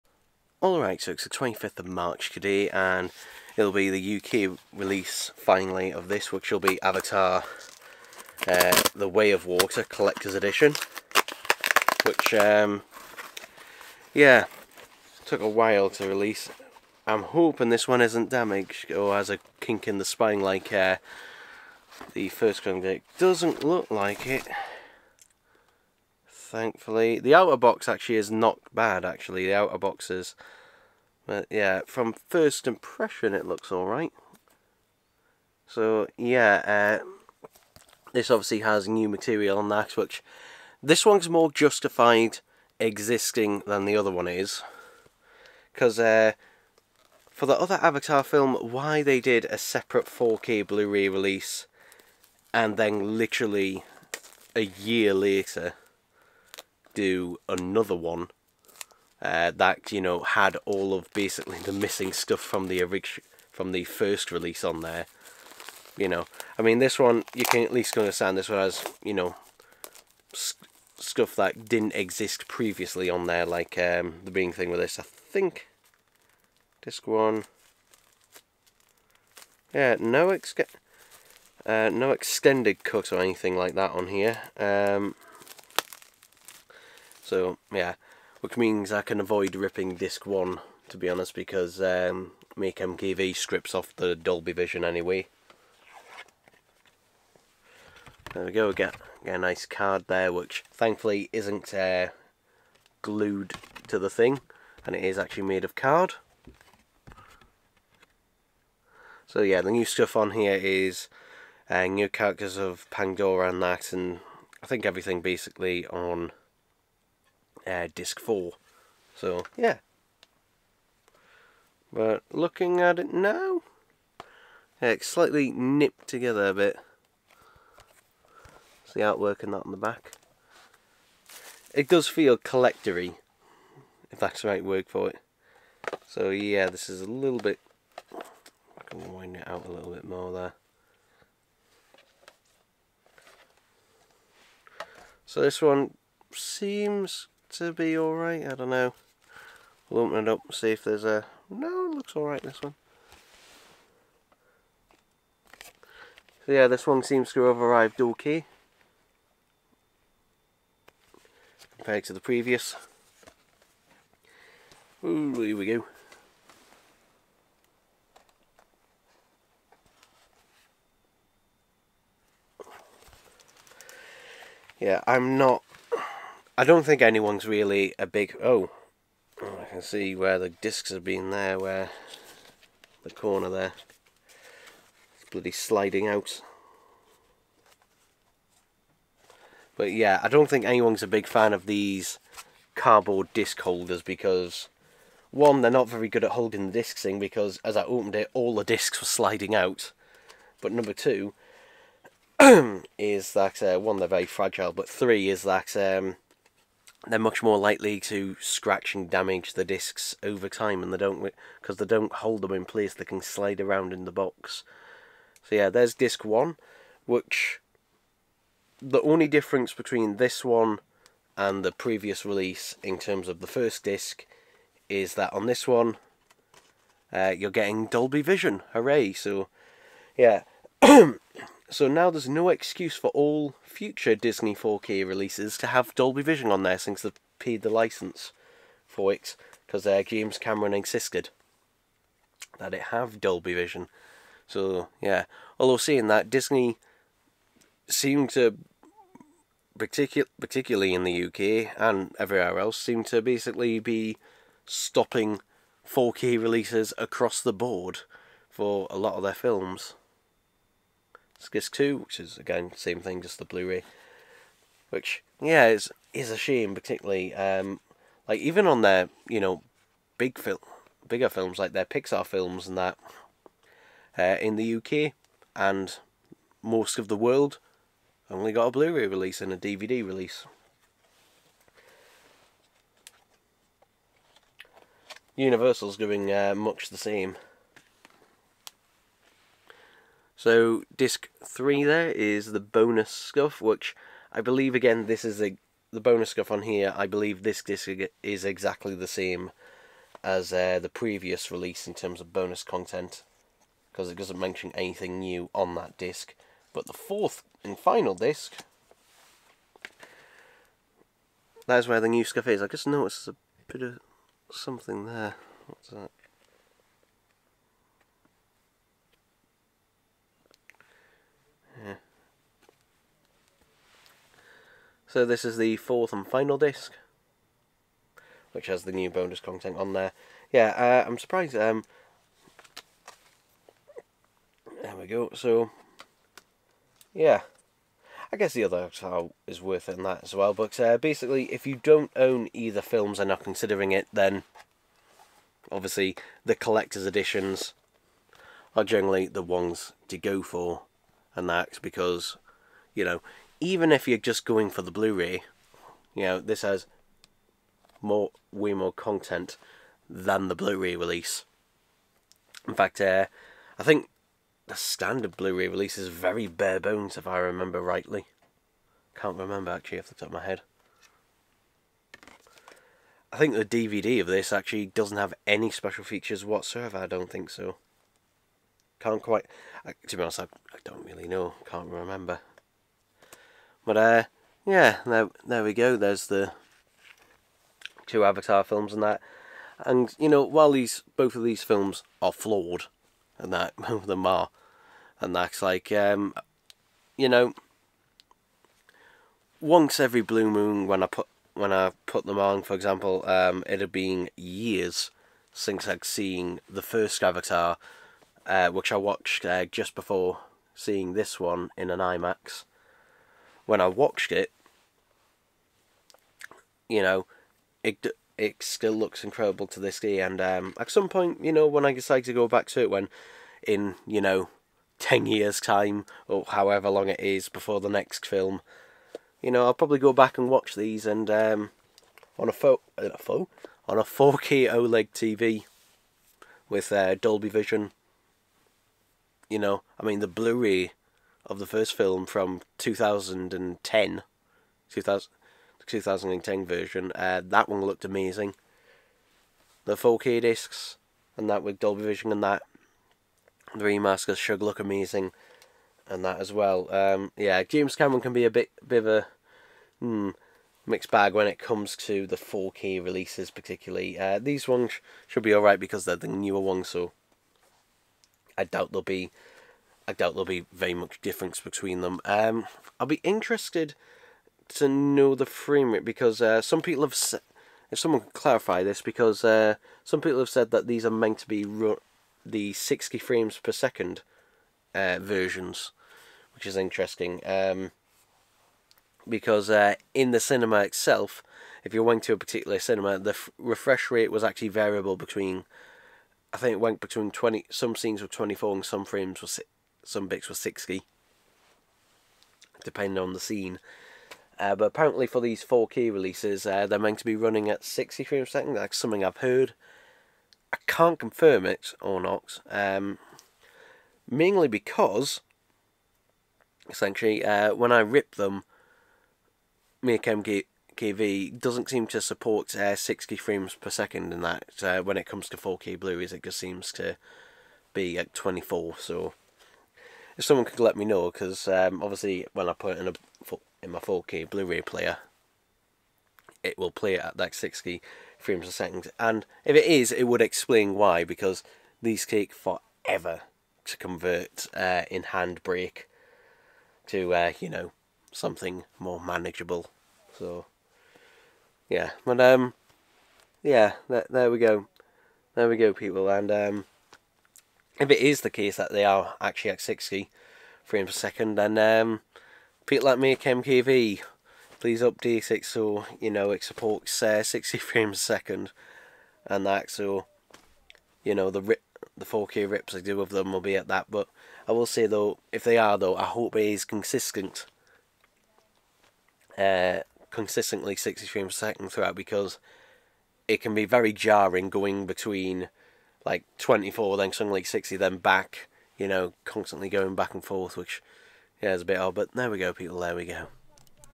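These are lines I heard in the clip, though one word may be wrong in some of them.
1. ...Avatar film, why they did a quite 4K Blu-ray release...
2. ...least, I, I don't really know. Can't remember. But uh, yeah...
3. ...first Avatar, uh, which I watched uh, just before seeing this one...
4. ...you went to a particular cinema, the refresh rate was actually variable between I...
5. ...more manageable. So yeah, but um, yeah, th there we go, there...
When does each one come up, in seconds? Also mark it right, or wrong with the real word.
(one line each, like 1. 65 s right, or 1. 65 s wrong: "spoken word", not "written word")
1. 47 s wrong: "separate", not "quite"
2. 380 s wrong: "honest", not "least"
3. 406 s right
4. 491 s right
5. 548 s right.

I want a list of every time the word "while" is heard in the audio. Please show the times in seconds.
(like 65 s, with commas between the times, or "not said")
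15 s, 390 s.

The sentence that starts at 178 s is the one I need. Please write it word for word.
Oh, oh, I can see where the discs have been there, where the corner there.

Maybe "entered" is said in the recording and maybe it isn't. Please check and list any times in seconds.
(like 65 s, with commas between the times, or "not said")
not said.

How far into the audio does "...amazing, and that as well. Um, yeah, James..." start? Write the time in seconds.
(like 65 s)
454 s.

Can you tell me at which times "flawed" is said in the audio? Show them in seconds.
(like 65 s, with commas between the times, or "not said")
392 s.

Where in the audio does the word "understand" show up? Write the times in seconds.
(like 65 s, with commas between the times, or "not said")
67 s.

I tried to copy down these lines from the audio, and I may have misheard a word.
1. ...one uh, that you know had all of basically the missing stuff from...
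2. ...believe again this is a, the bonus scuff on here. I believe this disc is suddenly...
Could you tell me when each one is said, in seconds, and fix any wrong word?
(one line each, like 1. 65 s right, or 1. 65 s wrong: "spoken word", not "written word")
1. 57 s right
2. 294 s wrong: "exactly", not "suddenly".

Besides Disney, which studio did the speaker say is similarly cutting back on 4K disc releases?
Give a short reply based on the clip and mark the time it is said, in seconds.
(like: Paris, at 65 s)
Universal, at 285 s.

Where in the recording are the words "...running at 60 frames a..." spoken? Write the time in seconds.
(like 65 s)
507 s.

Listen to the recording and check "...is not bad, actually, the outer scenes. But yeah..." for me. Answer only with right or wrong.
wrong.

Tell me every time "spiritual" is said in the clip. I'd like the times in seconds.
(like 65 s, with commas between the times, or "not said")
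not said.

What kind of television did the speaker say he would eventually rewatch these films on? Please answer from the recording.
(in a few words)
4K OLED TV.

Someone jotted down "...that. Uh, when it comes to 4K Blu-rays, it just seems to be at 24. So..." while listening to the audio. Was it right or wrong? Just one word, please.
right.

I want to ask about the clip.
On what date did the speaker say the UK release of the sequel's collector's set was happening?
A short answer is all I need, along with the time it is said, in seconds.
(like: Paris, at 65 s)
25th of March, at 1 s.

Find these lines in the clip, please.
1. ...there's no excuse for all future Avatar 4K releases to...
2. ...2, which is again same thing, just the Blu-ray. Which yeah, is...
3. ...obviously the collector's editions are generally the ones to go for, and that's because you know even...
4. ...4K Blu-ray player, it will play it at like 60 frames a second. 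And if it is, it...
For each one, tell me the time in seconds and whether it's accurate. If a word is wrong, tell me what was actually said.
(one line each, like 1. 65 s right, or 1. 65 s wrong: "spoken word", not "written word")
1. 232 s wrong: "Disney", not "Avatar"
2. 261 s right
3. 345 s right
4. 533 s right.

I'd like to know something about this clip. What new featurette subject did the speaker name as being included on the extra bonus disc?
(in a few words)
new characters of Pandora.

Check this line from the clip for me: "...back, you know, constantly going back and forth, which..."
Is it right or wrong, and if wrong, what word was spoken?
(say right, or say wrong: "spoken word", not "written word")
right.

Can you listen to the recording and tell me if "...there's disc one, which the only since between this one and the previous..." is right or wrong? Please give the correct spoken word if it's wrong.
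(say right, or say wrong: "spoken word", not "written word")
wrong: "difference", not "since".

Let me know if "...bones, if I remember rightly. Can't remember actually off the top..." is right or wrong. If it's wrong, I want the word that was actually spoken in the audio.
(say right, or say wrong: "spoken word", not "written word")
right.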